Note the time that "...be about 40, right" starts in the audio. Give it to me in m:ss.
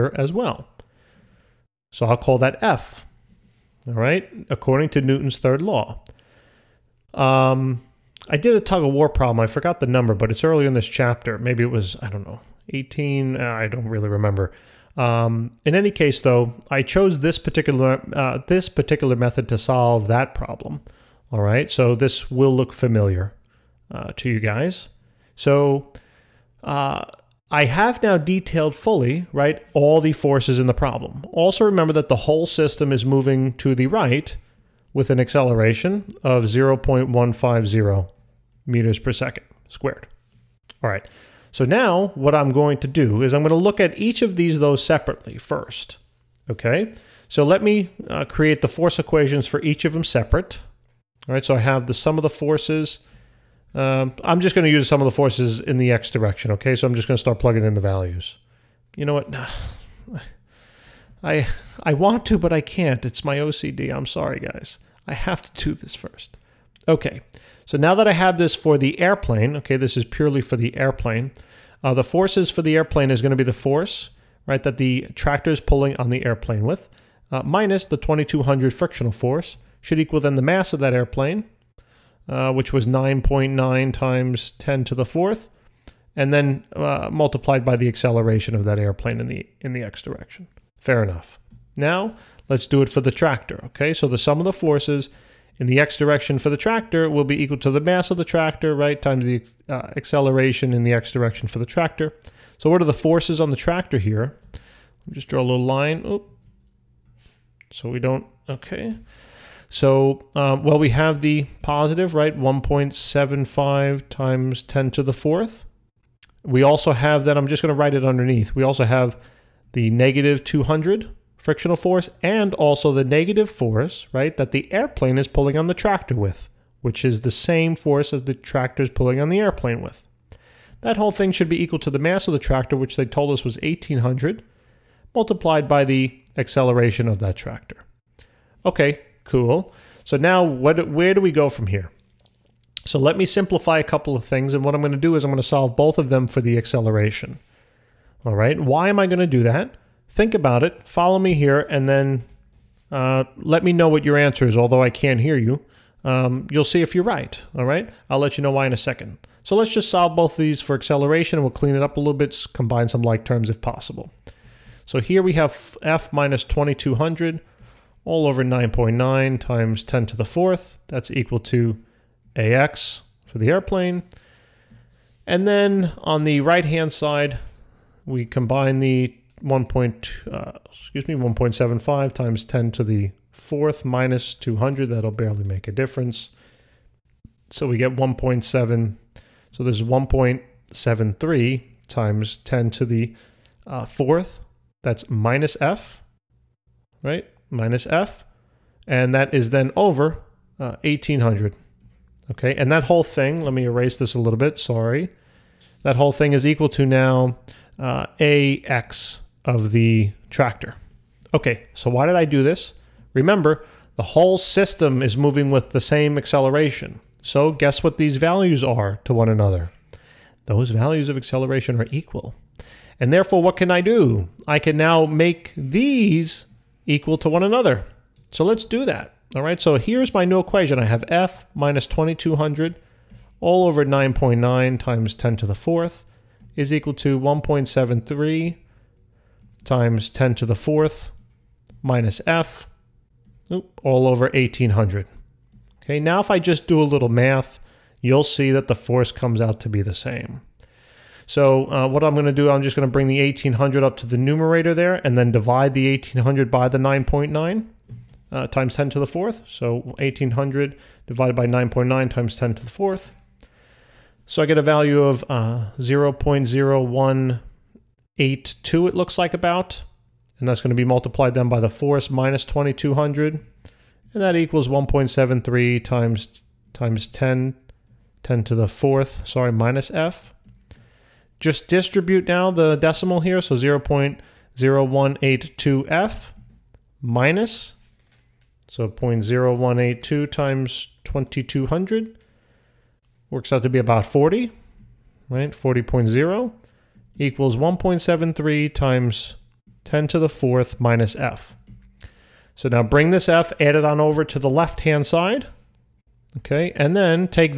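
4:53.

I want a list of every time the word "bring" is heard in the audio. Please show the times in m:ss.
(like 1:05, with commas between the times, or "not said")
4:12, 5:02.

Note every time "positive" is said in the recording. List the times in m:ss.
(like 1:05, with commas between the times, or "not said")
1:51.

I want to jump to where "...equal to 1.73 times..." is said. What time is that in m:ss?
3:56.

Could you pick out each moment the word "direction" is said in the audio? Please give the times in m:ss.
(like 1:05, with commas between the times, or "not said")
0:56, 1:30, 1:35, 1:41.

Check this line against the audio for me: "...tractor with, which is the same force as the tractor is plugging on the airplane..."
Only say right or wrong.
wrong.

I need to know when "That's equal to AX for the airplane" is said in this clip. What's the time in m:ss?
2:50.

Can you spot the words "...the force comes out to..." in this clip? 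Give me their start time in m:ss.
4:08.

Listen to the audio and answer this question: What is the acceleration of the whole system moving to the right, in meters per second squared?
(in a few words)
0.150.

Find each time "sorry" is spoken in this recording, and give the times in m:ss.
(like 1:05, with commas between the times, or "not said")
1:04, 3:24, 4:39.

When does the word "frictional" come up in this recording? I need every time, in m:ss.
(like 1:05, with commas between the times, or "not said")
1:18, 2:01.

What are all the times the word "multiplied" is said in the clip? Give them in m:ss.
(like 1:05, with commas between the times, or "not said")
1:27, 2:15, 4:30.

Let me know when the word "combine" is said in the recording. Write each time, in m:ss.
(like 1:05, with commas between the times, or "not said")
2:42, 2:58.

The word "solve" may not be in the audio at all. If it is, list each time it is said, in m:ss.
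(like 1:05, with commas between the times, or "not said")
0:19, 2:25, 2:39.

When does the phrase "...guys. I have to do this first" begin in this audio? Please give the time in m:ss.
1:04.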